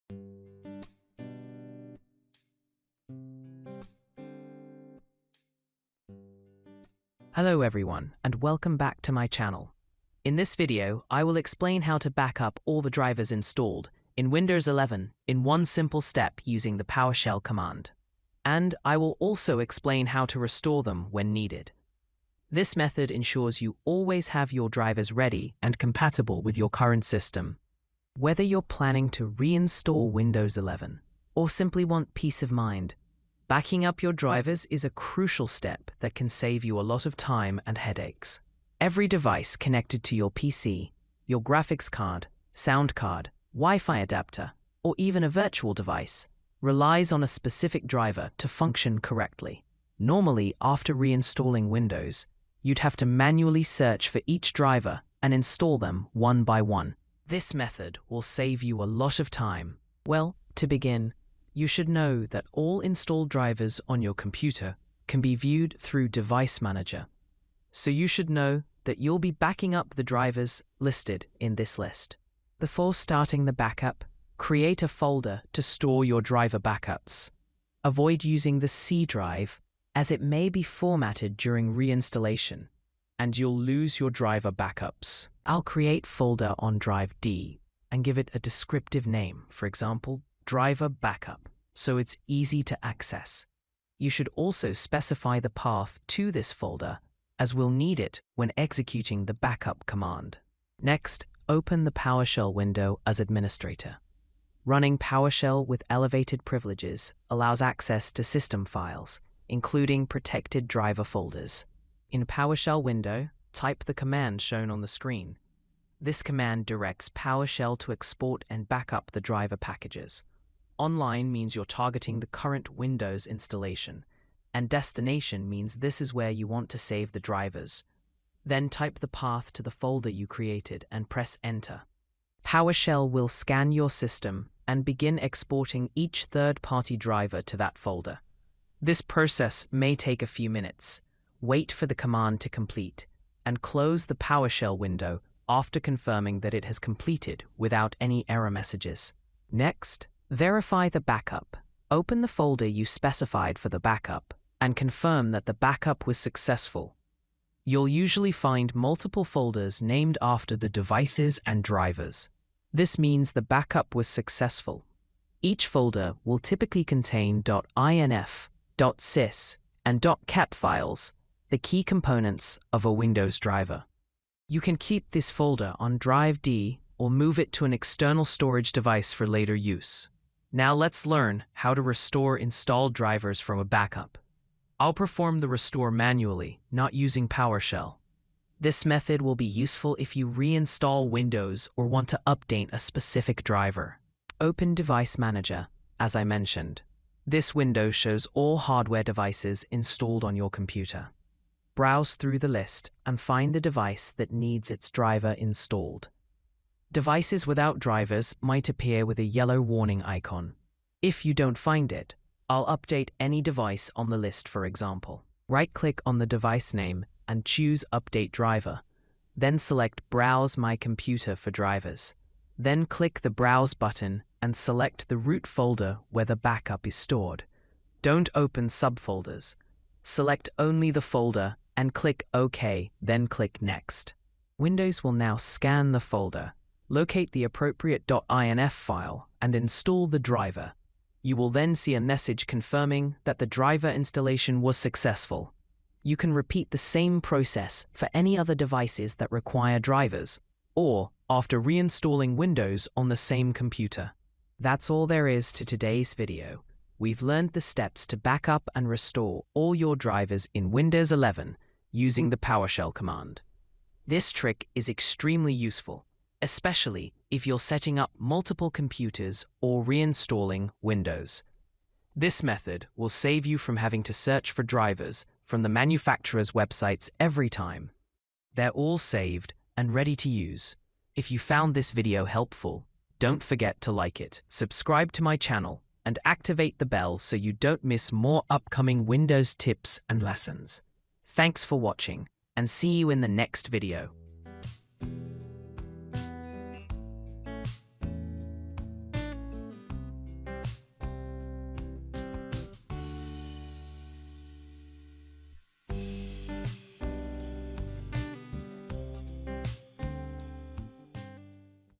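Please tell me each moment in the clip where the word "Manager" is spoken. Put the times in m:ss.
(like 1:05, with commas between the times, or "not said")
1:06, 3:15.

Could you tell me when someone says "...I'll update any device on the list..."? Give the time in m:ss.
3:32.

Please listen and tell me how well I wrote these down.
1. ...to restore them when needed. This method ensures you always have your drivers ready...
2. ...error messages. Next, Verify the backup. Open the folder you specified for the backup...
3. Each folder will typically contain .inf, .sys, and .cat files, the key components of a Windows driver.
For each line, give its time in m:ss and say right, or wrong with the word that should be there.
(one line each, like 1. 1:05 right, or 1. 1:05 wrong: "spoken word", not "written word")
1. 0:20 right
2. 2:28 right
3. 2:45 right.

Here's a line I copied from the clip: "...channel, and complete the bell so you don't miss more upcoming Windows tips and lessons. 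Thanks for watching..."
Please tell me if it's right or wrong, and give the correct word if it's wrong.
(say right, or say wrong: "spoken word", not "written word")
wrong: "activate", not "complete".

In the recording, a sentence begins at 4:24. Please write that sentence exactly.
This trick is extremely useful especially if you're setting up multiple computers or reinstalling Windows.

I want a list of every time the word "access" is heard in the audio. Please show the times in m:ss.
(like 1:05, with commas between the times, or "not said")
1:32, 1:47.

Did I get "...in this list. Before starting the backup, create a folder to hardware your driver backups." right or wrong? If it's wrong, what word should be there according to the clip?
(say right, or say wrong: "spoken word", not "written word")
wrong: "store", not "hardware".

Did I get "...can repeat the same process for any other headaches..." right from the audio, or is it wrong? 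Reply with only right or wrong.
wrong.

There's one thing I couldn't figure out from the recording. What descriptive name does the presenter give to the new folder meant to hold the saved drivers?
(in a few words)
driver backup.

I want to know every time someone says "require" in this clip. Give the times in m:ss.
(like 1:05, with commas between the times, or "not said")
4:09.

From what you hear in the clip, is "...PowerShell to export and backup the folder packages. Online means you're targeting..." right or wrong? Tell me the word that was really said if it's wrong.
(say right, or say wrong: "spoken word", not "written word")
wrong: "driver", not "folder".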